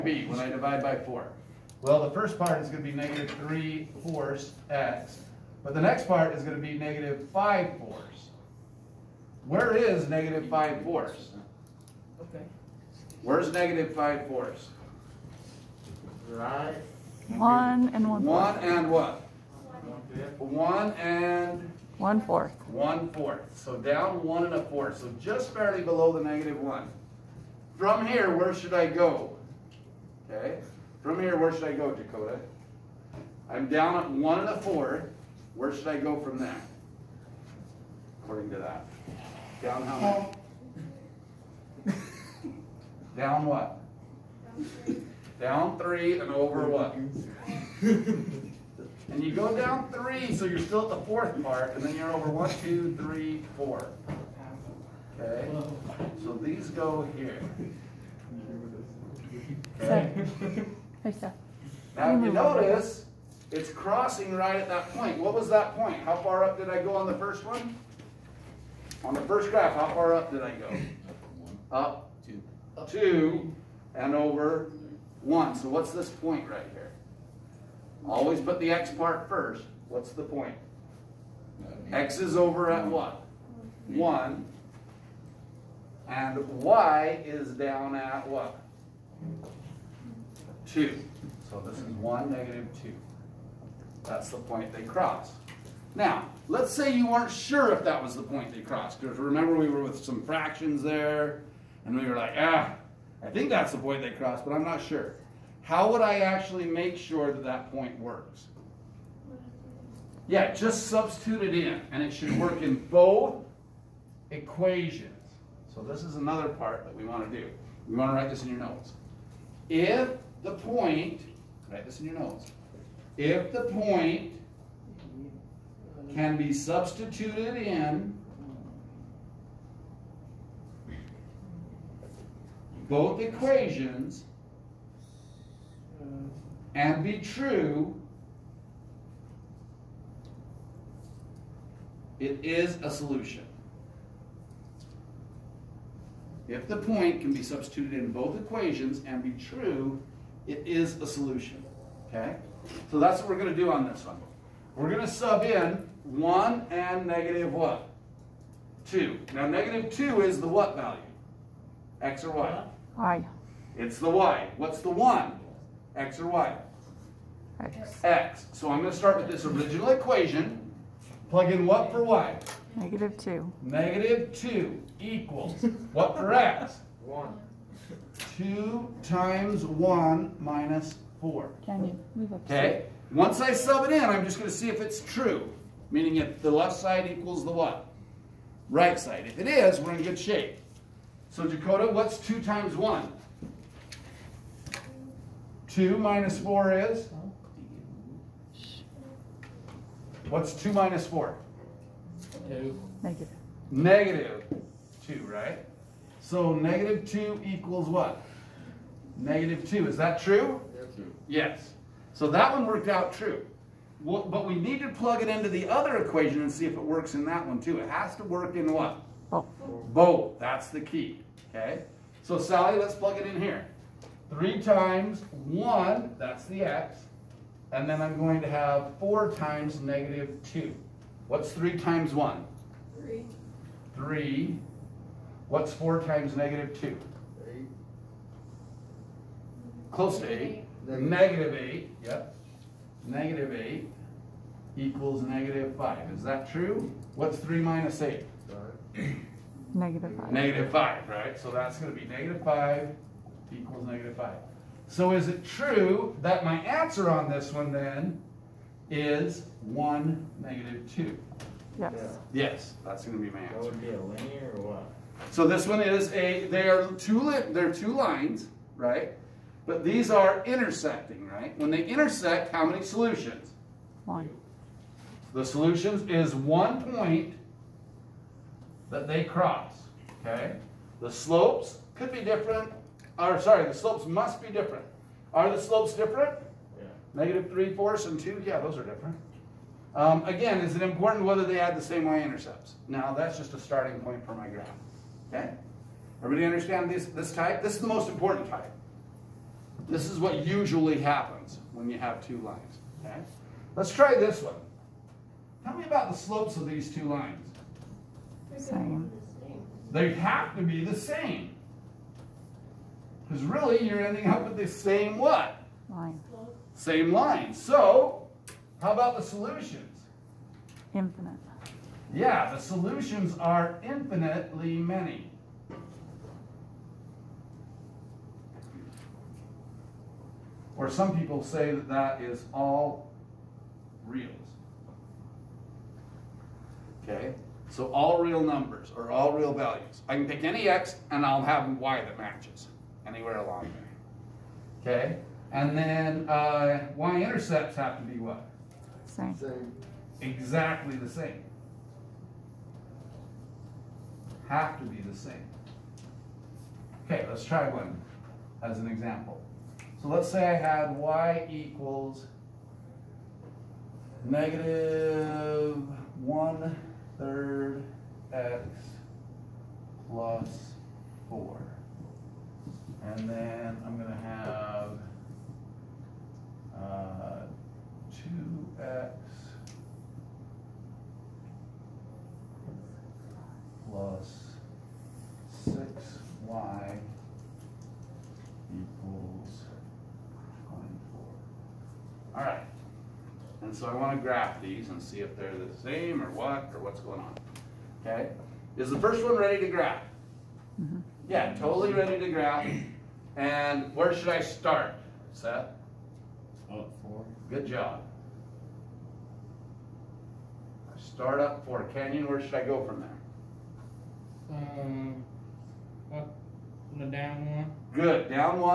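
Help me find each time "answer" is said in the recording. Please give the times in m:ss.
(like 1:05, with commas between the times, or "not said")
4:16, 4:23.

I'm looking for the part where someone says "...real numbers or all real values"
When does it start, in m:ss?
5:38.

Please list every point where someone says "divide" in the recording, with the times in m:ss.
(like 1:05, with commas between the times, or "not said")
0:00.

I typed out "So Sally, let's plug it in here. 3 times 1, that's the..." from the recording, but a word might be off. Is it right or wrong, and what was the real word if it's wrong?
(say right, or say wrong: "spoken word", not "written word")
right.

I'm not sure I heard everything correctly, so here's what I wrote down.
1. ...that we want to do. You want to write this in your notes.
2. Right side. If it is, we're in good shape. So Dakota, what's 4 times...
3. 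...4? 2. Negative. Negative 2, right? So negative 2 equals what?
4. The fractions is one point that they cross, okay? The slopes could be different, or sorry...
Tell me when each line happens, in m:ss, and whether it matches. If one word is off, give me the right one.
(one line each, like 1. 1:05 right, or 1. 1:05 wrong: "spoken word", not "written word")
1. 1:56 right
2. 3:08 wrong: "2", not "4"
3. 3:21 right
4. 4:35 wrong: "solutions", not "fractions".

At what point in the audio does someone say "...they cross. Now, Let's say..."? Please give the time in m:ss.
1:34.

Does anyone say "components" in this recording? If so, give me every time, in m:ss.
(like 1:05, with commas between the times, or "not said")
not said.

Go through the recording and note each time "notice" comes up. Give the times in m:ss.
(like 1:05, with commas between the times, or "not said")
1:02.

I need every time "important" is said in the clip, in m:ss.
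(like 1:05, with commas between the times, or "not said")
4:50, 4:58.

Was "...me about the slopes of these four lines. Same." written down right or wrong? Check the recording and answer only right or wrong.
wrong.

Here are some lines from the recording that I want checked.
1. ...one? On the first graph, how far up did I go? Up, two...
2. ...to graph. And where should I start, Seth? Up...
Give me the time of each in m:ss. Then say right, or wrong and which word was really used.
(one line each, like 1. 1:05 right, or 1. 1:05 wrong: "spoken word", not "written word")
1. 1:07 right
2. 6:42 right.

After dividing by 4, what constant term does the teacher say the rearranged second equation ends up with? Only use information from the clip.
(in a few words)
-5/4.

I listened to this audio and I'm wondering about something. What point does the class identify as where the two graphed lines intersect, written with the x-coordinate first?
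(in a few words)
(1, -2).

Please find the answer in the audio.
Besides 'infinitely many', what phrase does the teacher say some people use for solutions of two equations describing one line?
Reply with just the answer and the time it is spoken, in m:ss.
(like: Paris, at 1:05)
all reals, at 5:32.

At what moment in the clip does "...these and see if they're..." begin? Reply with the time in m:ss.
6:34.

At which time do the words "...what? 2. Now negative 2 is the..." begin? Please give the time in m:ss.
2:37.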